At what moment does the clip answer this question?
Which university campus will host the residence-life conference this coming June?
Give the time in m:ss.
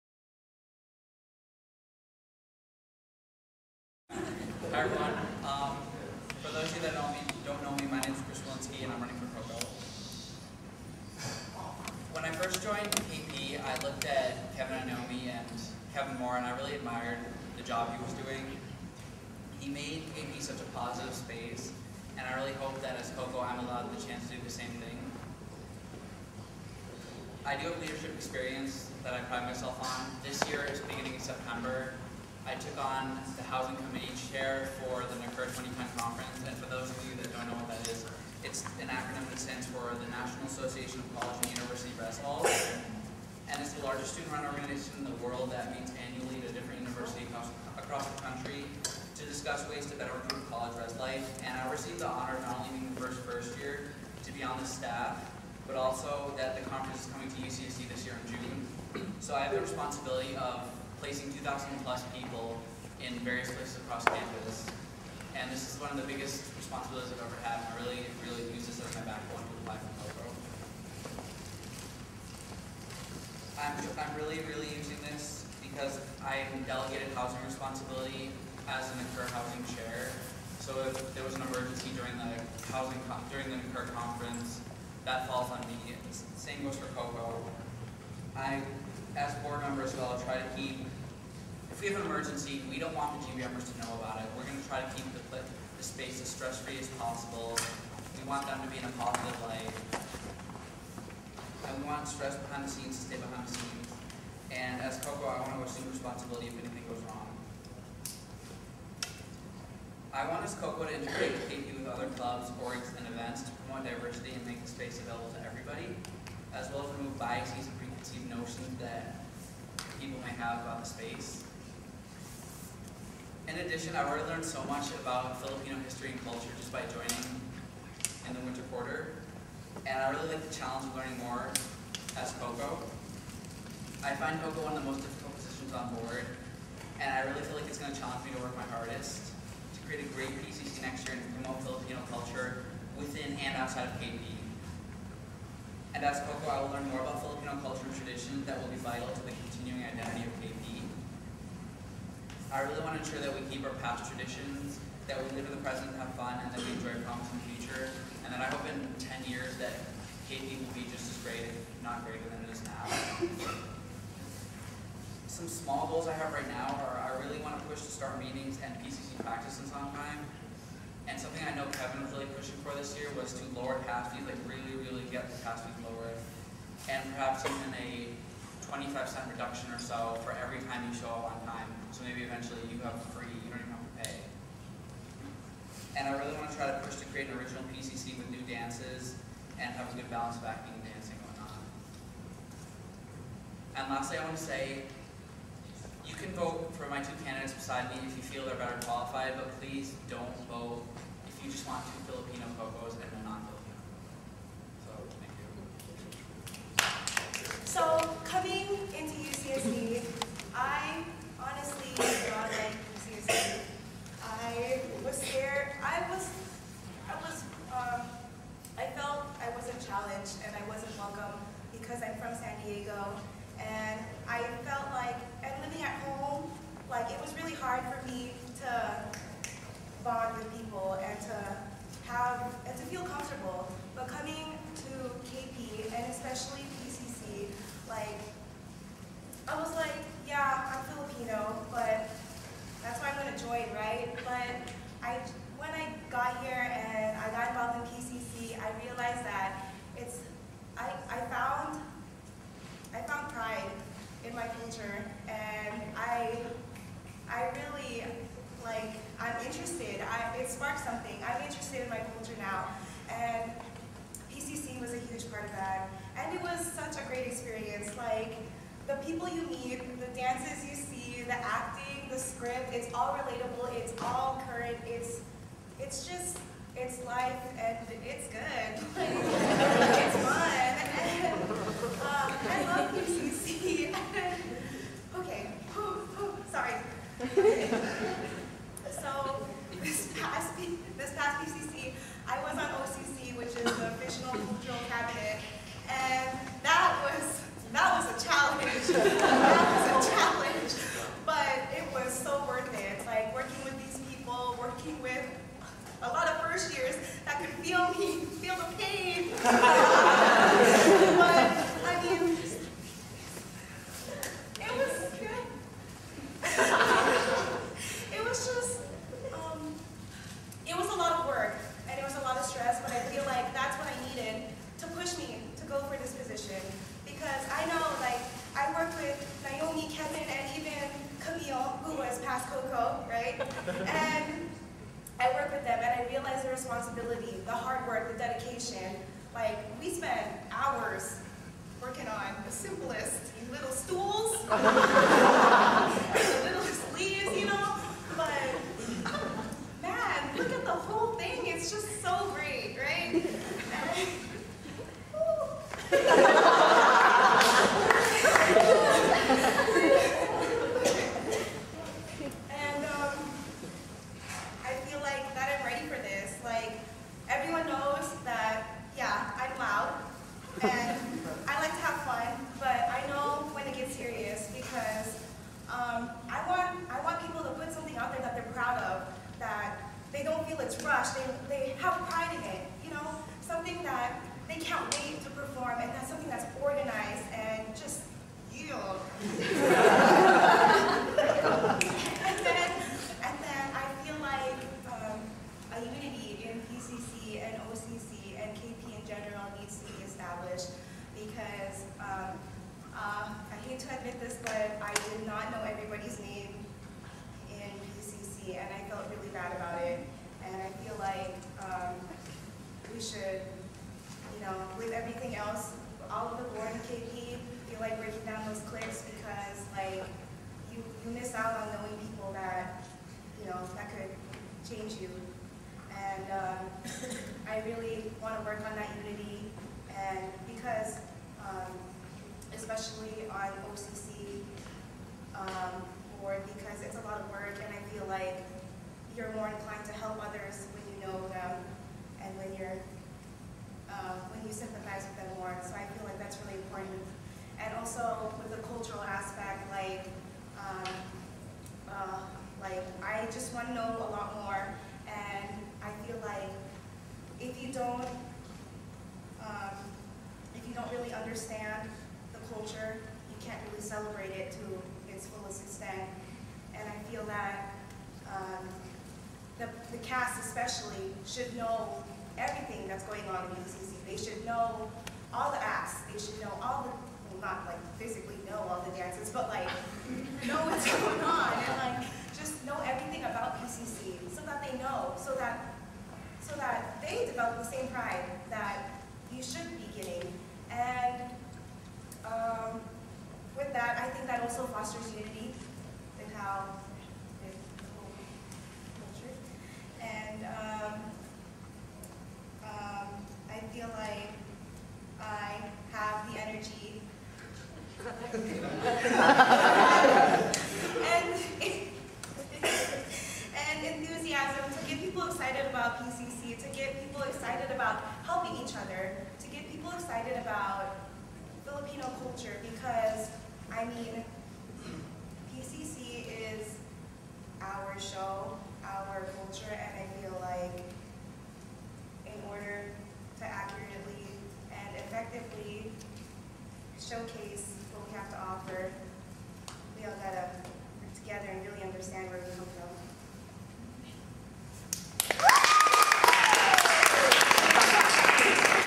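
0:57.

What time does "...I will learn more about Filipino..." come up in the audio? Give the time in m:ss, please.
2:26.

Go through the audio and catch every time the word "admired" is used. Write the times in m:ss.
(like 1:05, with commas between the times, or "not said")
0:16.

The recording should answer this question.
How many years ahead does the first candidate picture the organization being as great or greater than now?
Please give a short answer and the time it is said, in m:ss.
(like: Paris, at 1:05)
10 years, at 2:38.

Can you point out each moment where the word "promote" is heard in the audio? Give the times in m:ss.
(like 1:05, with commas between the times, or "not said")
1:53, 2:21.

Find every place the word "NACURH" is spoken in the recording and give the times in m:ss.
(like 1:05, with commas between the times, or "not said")
1:19, 1:23.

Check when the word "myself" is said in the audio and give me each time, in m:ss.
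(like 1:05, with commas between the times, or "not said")
0:29.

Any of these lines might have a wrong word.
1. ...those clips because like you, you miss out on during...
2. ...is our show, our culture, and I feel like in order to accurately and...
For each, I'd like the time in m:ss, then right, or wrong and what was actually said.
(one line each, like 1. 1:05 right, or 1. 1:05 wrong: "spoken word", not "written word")
1. 6:58 wrong: "knowing", not "during"
2. 8:46 right.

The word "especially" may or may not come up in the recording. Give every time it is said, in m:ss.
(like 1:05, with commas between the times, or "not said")
3:56, 7:50.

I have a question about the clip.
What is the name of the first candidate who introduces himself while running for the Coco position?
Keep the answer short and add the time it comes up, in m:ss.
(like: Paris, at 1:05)
Chris Walensky, at 0:08.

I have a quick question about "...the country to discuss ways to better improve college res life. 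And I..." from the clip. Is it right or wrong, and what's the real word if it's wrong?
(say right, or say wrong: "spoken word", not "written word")
right.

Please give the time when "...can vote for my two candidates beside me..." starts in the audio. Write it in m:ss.
3:16.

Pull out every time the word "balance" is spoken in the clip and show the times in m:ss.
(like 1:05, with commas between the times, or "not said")
3:10.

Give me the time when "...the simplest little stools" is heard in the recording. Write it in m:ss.
5:42.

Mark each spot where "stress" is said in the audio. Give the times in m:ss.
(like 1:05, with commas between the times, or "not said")
1:36, 1:42.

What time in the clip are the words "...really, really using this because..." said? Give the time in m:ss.
1:14.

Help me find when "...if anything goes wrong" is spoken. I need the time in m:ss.
1:46.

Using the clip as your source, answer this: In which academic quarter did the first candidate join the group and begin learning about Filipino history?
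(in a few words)
winter quarter.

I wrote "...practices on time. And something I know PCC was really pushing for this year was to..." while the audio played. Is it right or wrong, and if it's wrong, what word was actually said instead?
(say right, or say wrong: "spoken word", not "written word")
wrong: "Kevin", not "PCC".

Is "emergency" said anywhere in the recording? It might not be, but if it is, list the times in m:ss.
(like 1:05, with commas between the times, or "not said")
1:21, 1:32.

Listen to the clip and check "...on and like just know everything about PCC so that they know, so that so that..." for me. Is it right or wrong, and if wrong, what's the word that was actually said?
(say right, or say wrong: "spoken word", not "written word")
right.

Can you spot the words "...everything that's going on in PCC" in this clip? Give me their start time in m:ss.
7:52.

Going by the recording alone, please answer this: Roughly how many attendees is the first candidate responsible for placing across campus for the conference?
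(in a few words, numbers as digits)
2,000 plus.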